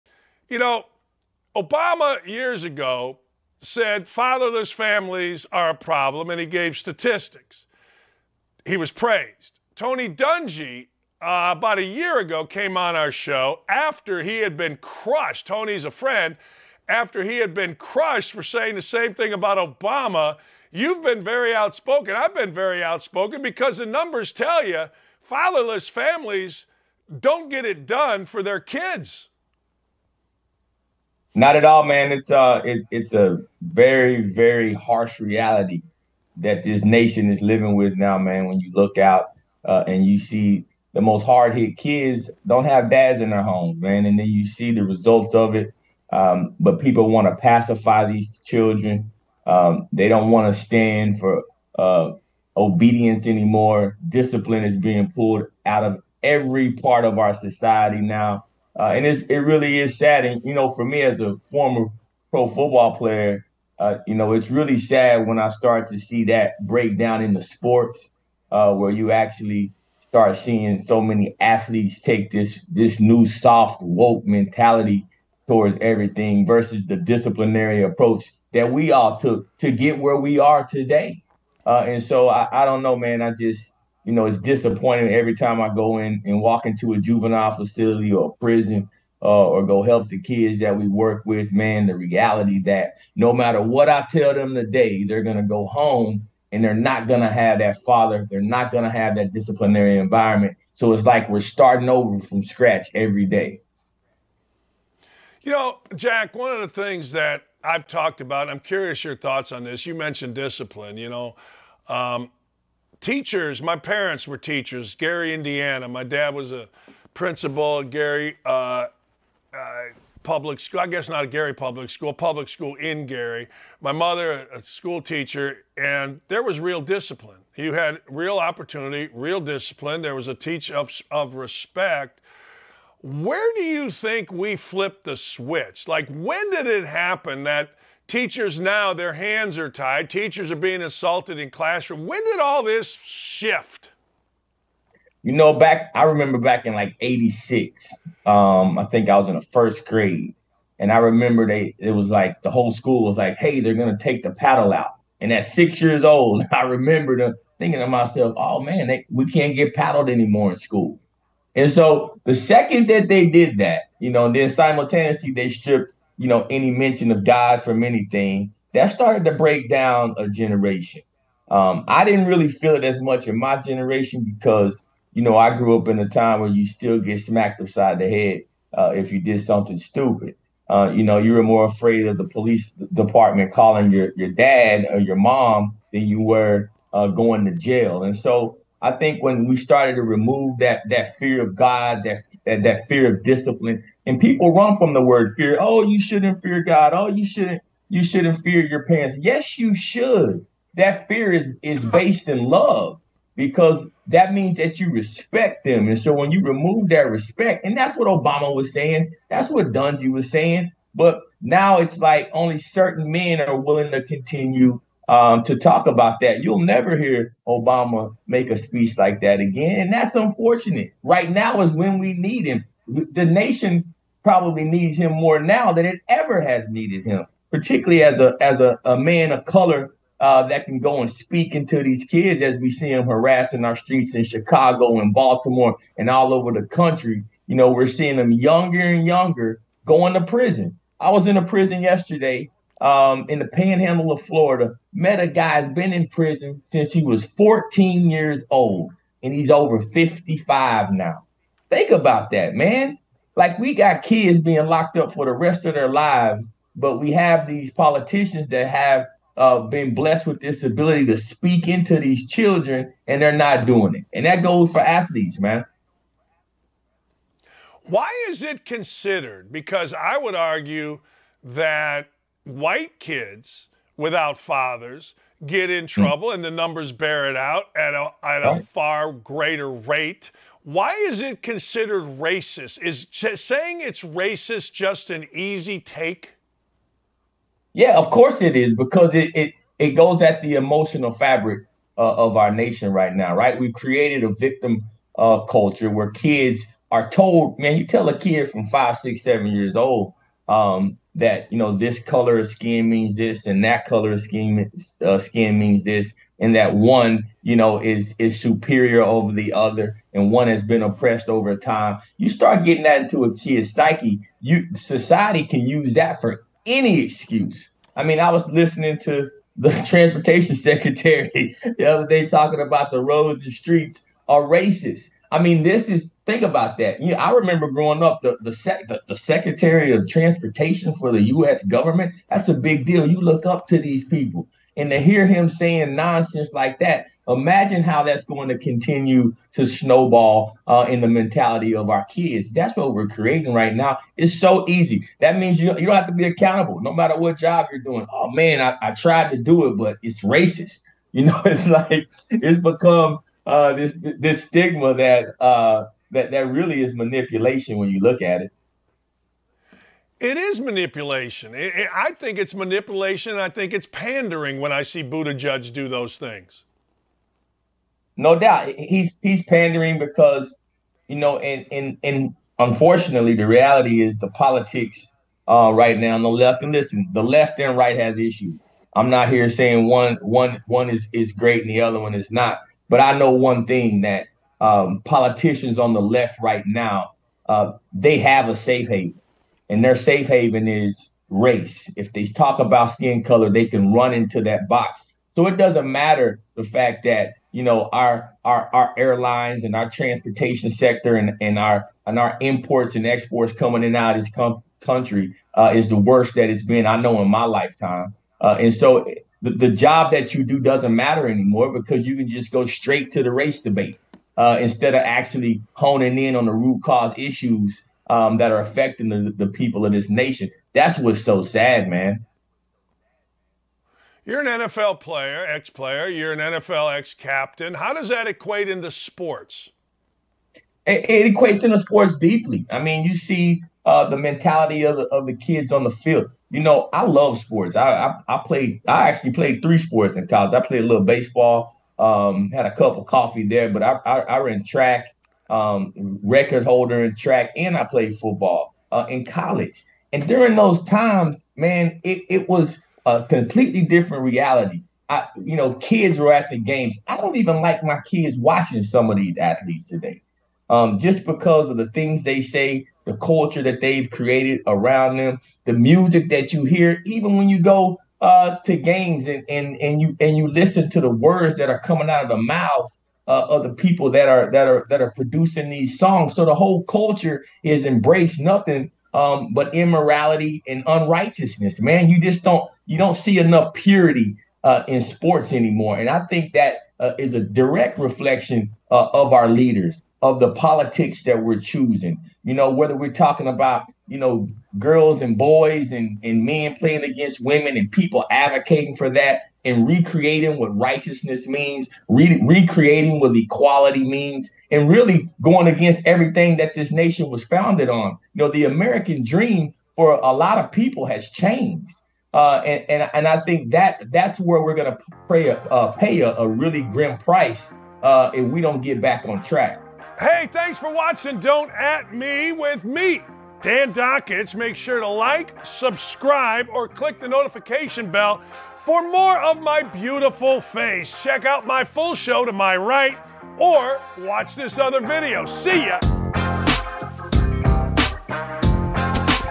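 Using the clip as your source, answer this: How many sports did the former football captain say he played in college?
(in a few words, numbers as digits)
3.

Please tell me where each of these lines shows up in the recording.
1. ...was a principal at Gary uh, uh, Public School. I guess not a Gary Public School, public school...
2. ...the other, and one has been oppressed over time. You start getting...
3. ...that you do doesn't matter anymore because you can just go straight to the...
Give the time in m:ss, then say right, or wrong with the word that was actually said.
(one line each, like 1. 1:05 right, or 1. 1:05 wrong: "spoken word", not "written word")
1. 1:56 right
2. 5:09 right
3. 6:50 right.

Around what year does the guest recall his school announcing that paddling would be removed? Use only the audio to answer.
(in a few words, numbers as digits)
1986.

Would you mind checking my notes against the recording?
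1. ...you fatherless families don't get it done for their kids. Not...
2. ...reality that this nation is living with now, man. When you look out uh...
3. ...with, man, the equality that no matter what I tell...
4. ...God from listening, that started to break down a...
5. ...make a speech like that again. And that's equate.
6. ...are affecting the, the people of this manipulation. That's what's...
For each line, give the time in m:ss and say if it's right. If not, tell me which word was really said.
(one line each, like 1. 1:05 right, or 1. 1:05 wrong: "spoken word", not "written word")
1. 0:24 right
2. 0:35 right
3. 1:31 wrong: "reality", not "equality"
4. 2:47 wrong: "anything", not "listening"
5. 3:38 wrong: "unfortunate", not "equate"
6. 6:58 wrong: "nation", not "manipulation".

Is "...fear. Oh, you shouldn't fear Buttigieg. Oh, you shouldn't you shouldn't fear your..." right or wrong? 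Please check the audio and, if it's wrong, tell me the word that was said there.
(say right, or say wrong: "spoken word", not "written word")
wrong: "God", not "Buttigieg".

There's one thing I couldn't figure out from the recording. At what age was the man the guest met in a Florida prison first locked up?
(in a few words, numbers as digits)
14.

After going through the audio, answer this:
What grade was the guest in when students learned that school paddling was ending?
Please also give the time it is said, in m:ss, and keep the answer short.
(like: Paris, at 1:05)
first grade, at 2:29.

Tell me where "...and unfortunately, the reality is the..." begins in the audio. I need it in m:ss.
6:12.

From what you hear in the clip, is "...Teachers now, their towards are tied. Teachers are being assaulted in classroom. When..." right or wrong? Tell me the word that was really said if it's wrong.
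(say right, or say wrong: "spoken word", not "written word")
wrong: "hands", not "towards".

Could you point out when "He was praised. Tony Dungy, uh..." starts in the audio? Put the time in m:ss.
0:08.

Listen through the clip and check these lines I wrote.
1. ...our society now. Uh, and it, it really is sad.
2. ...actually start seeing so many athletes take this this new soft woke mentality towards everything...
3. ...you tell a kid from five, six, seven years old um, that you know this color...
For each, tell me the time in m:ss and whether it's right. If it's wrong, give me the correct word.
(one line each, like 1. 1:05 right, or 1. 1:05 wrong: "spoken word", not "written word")
1. 0:57 right
2. 1:09 right
3. 4:57 right.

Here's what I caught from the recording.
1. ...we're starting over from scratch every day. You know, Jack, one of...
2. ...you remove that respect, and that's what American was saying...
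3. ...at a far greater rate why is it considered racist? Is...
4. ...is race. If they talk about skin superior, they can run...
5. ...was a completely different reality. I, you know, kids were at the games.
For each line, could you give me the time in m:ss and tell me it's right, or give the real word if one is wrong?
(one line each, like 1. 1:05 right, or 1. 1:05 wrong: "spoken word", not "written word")
1. 1:41 right
2. 3:26 wrong: "Obama", not "American"
3. 4:38 right
4. 6:30 wrong: "color", not "superior"
5. 7:32 right.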